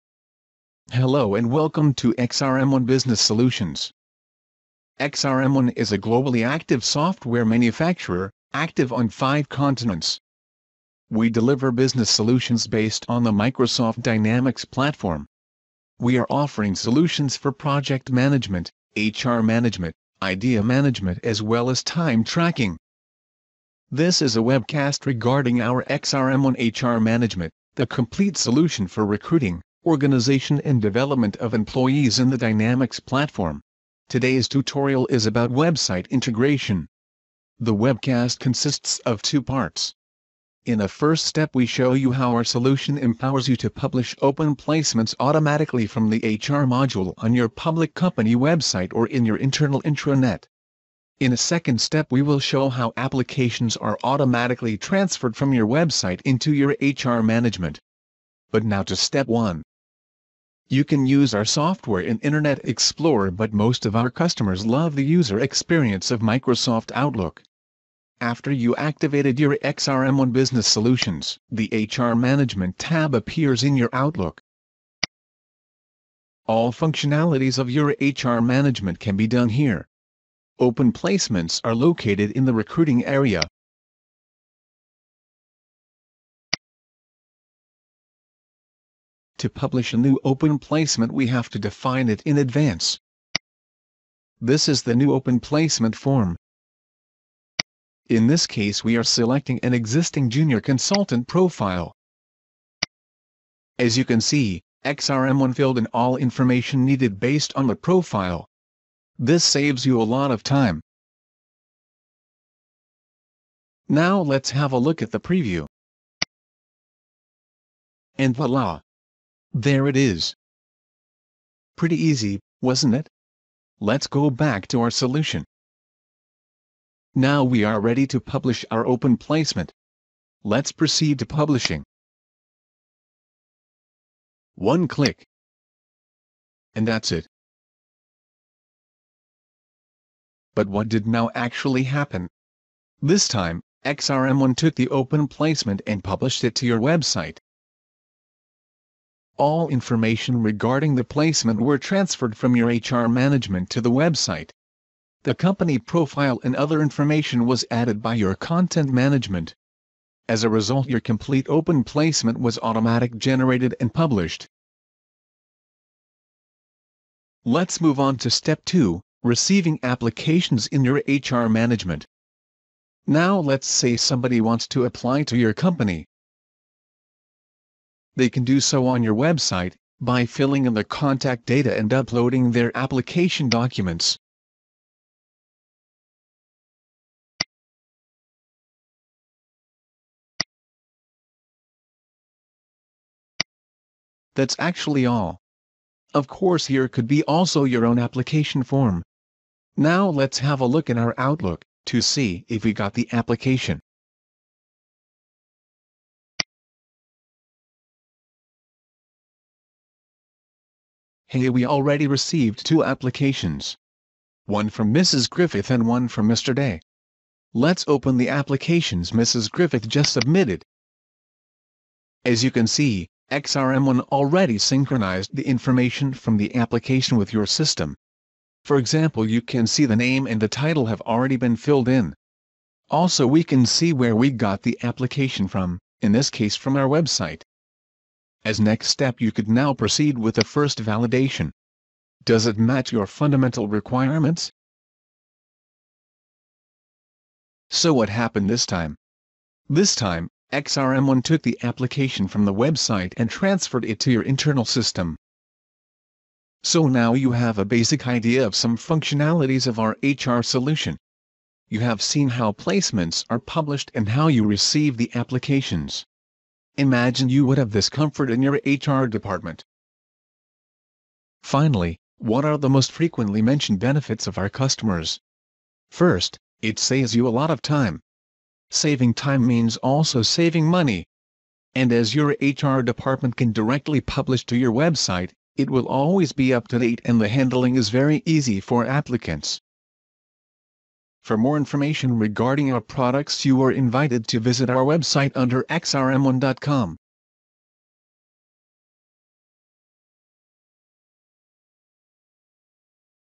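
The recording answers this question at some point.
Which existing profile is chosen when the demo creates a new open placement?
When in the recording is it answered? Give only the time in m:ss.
1:40.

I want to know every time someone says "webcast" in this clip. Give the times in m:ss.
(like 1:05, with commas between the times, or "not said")
0:24, 0:37.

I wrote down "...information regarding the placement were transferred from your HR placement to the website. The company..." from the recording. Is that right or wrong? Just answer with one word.
wrong.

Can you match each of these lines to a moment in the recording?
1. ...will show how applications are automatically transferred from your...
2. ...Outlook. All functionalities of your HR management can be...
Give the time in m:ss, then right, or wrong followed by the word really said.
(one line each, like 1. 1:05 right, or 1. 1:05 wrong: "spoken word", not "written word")
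1. 0:52 right
2. 1:13 right.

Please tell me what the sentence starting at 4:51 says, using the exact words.
For more information regarding our products you are invited to visit our website under xrm1.com.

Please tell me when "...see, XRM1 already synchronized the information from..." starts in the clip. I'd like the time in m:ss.
3:42.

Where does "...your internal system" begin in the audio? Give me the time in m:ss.
4:14.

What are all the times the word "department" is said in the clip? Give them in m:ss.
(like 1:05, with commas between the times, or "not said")
4:29, 4:42.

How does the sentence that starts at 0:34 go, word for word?
Today's tutorial is about website integration.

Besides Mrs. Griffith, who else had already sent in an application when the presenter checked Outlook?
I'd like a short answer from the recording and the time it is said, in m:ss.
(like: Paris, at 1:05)
Mr. 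Day, at 3:36.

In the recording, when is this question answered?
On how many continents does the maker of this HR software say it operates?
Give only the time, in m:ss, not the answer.
0:09.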